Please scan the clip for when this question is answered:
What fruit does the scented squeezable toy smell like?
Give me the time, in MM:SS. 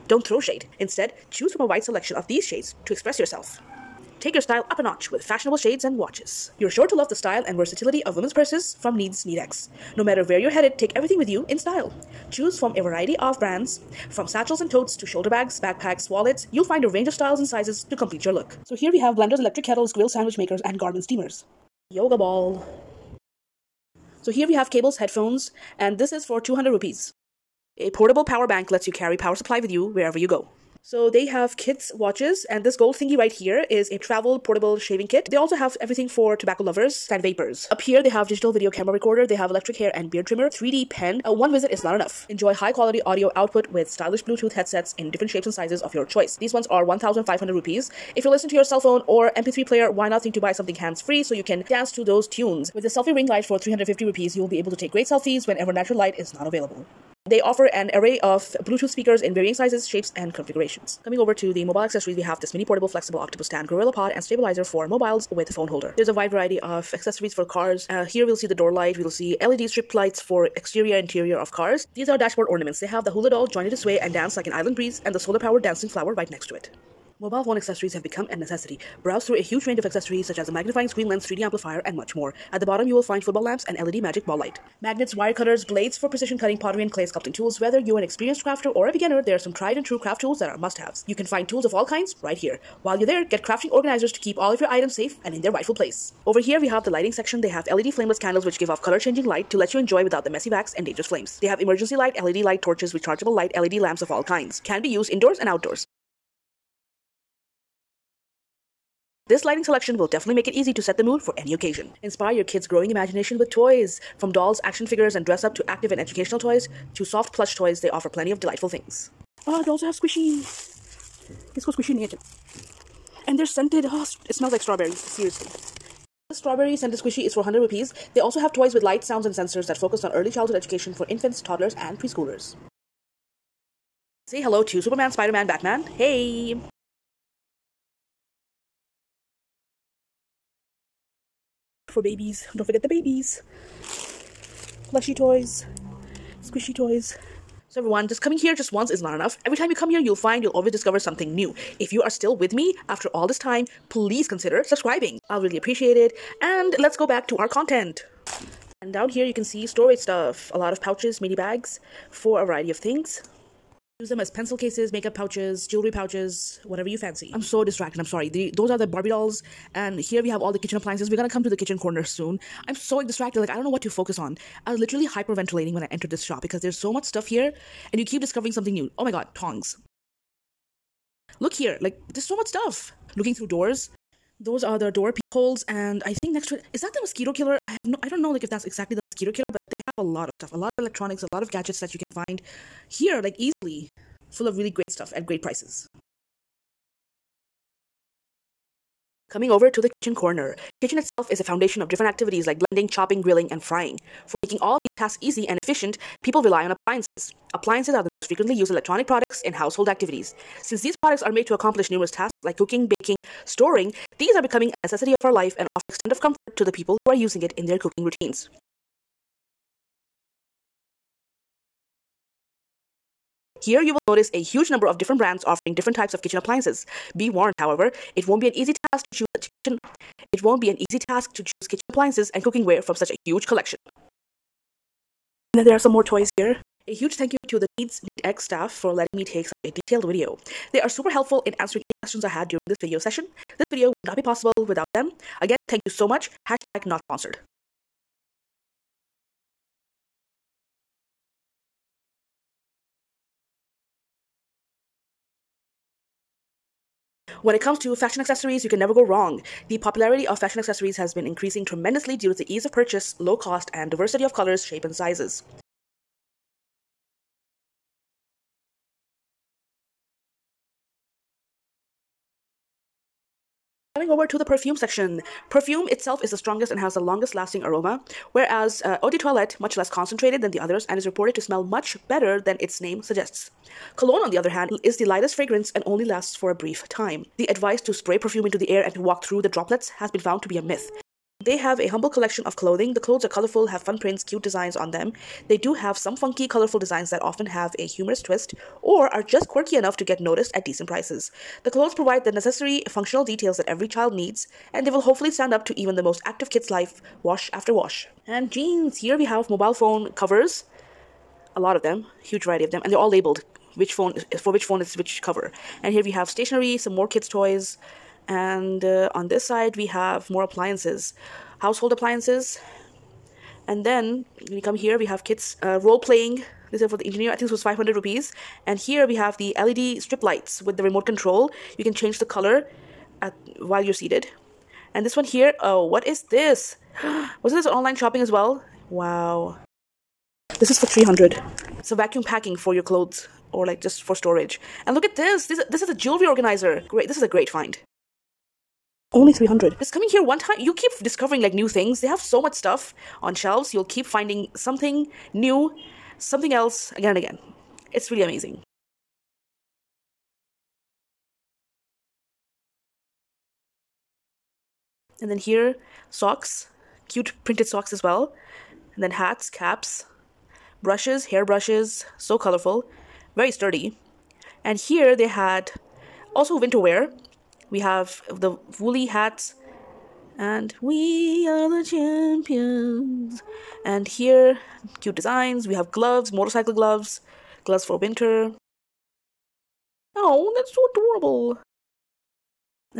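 02:04.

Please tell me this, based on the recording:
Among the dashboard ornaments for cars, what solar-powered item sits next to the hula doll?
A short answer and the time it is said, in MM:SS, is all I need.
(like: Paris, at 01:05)
Dancing flower, at 01:15.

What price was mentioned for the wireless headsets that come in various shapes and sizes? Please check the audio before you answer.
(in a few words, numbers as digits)
1500 rupees.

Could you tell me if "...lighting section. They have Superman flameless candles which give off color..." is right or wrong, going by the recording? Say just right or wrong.
wrong.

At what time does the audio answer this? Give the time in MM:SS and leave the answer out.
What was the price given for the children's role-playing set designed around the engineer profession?
05:27.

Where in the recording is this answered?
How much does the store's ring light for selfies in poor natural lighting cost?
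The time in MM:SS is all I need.
00:53.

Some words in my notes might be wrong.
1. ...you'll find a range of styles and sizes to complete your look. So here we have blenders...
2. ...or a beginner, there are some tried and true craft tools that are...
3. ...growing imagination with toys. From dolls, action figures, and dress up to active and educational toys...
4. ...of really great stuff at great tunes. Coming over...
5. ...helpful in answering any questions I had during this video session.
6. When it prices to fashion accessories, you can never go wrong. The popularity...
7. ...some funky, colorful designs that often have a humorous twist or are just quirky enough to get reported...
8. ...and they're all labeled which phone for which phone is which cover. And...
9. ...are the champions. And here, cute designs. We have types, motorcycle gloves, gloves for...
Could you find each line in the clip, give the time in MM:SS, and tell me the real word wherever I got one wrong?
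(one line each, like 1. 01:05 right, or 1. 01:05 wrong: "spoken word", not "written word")
1. 00:16 right
2. 01:28 right
3. 01:52 right
4. 03:14 wrong: "prices", not "tunes"
5. 04:01 right
6. 04:17 wrong: "comes", not "prices"
7. 04:55 wrong: "noticed", not "reported"
8. 05:12 right
9. 06:21 wrong: "gloves", not "types".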